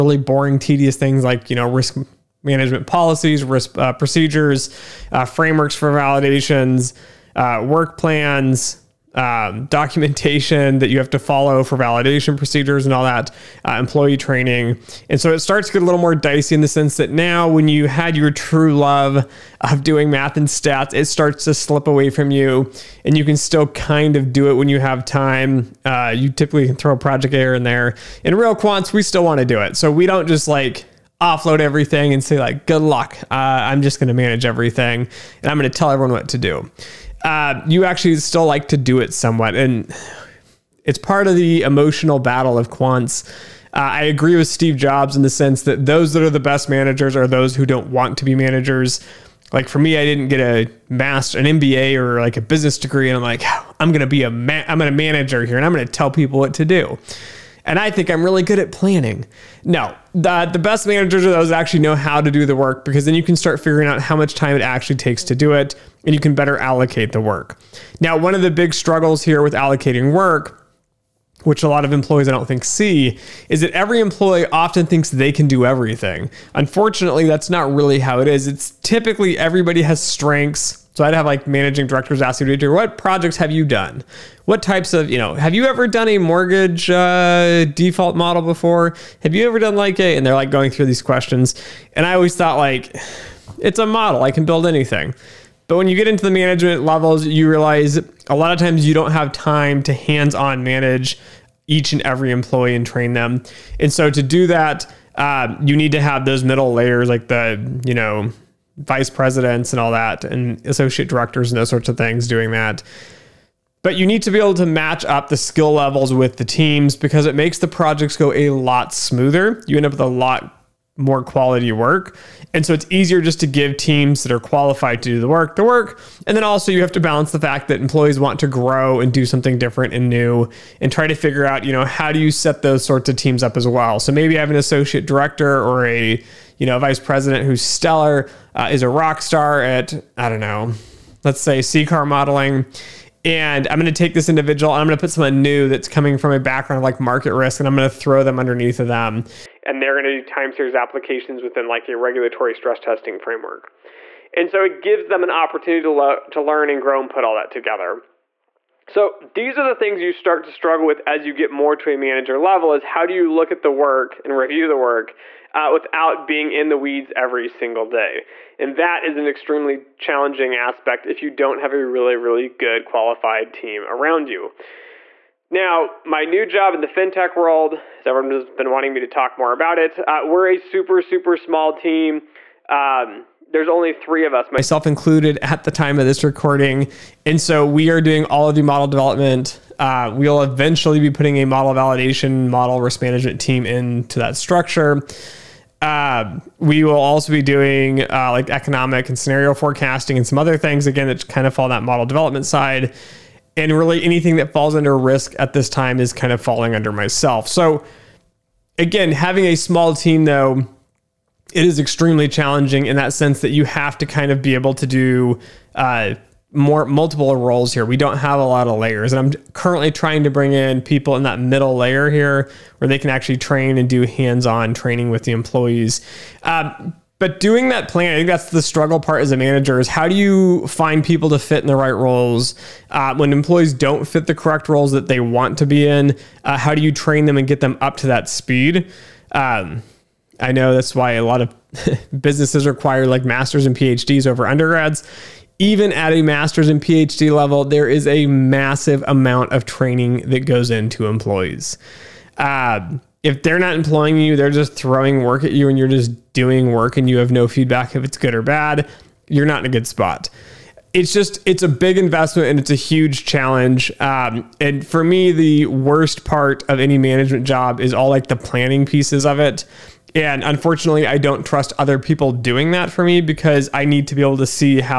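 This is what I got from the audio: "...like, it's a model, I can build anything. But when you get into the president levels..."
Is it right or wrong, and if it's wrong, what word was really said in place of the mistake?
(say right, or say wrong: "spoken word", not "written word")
wrong: "management", not "president".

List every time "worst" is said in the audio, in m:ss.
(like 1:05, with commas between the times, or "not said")
4:25.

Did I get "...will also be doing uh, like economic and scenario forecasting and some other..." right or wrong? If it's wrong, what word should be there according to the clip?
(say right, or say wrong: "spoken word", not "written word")
right.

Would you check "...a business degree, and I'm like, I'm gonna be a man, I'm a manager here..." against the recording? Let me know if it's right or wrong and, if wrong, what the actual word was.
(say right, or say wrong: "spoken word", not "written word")
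right.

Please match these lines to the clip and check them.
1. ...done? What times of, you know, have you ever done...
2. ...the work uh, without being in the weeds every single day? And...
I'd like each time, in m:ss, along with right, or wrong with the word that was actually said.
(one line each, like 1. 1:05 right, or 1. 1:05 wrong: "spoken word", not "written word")
1. 1:23 wrong: "types", not "times"
2. 2:44 right.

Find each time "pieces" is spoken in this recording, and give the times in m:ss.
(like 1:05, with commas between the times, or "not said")
4:28.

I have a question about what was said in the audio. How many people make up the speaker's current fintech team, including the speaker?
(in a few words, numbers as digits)
3.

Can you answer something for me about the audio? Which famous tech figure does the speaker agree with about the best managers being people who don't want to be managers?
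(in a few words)
Steve Jobs.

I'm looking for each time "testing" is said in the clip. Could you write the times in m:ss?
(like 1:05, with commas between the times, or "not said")
2:32.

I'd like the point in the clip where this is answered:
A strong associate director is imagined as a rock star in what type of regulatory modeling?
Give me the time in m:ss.
2:21.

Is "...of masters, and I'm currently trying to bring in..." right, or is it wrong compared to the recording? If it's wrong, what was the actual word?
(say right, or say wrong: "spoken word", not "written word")
wrong: "layers", not "masters".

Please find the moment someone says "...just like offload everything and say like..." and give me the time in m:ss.
0:30.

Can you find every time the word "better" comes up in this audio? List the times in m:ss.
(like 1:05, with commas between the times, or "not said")
1:06.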